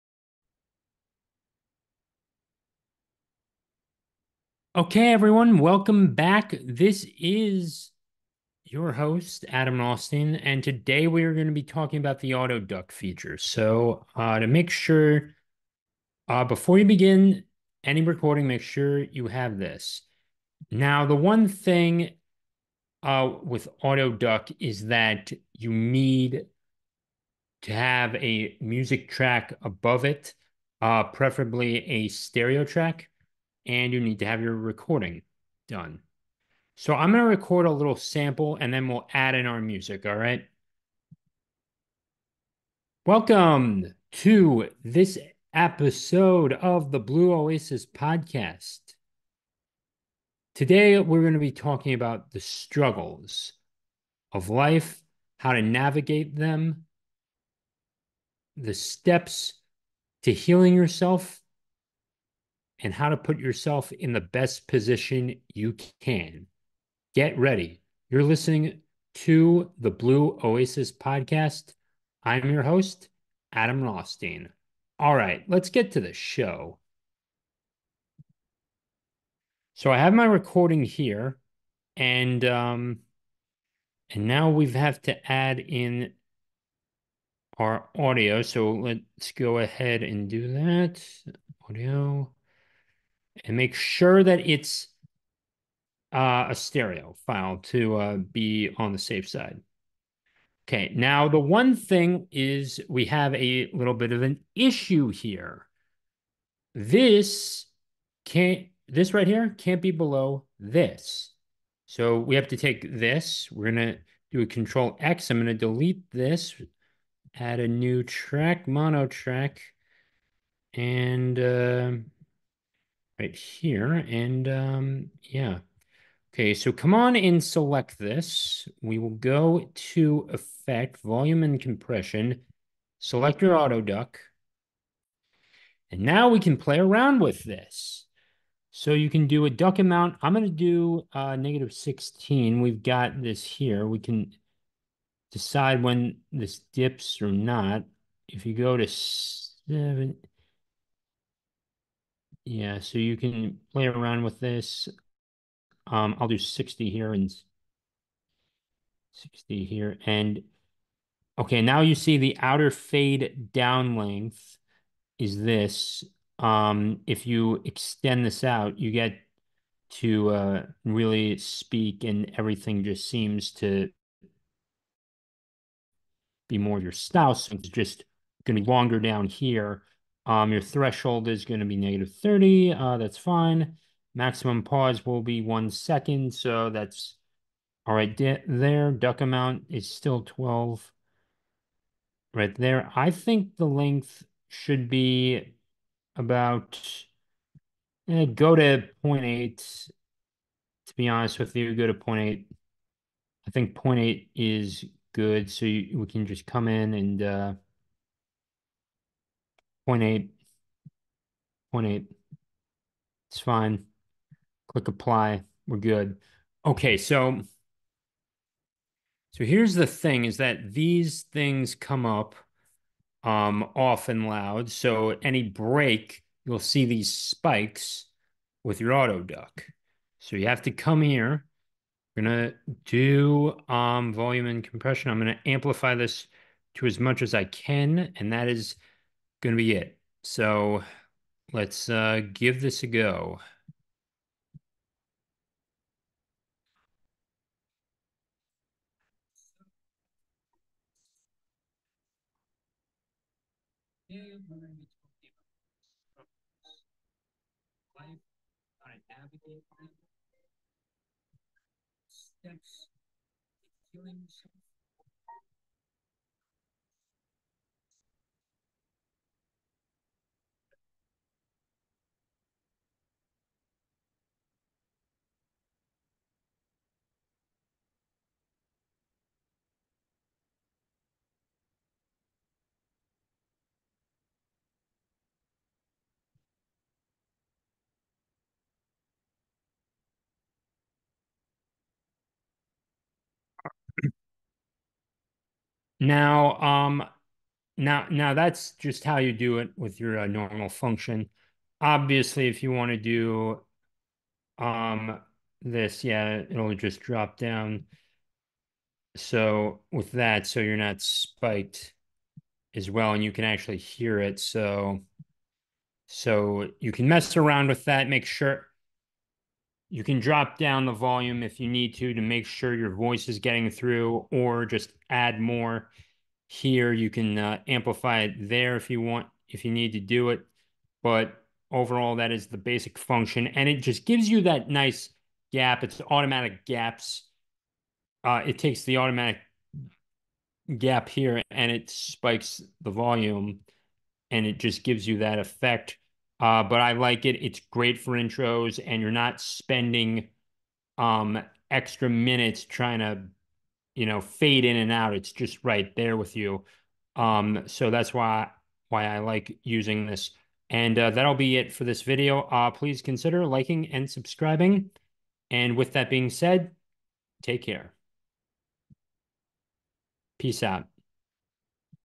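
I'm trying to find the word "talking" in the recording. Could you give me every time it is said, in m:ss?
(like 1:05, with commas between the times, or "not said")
0:11, 0:51.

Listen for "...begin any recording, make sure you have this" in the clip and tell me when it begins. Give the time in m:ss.
0:16.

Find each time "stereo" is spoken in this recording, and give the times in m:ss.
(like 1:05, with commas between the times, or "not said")
0:32, 1:36.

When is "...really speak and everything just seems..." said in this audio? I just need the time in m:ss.
2:50.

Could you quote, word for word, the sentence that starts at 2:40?
And okay, now you see the outer fade down length is this.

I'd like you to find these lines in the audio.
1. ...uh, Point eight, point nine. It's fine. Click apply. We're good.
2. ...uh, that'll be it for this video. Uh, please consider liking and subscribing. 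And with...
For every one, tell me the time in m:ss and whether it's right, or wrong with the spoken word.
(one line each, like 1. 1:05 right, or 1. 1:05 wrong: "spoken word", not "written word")
1. 3:27 wrong: "eight", not "nine"
2. 6:00 right.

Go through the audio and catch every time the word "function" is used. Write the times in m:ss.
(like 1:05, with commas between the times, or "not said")
5:00, 5:32.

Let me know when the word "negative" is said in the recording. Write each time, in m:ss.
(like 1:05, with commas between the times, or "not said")
2:21, 3:01.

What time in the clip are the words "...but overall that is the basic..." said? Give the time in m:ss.
5:31.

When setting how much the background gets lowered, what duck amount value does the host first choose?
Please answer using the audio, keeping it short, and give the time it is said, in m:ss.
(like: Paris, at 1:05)
-16, at 2:21.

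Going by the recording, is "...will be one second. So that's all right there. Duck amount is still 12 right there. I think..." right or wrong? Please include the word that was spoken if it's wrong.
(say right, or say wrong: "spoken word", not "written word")
right.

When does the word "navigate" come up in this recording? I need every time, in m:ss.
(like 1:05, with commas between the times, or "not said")
0:55.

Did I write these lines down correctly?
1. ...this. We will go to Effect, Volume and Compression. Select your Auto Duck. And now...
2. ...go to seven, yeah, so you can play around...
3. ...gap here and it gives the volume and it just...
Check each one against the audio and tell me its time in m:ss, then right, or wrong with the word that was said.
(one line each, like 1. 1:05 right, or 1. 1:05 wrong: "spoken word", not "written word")
1. 2:07 right
2. 2:28 right
3. 5:40 wrong: "spikes", not "gives".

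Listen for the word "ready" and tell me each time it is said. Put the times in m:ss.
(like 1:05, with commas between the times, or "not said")
1:07.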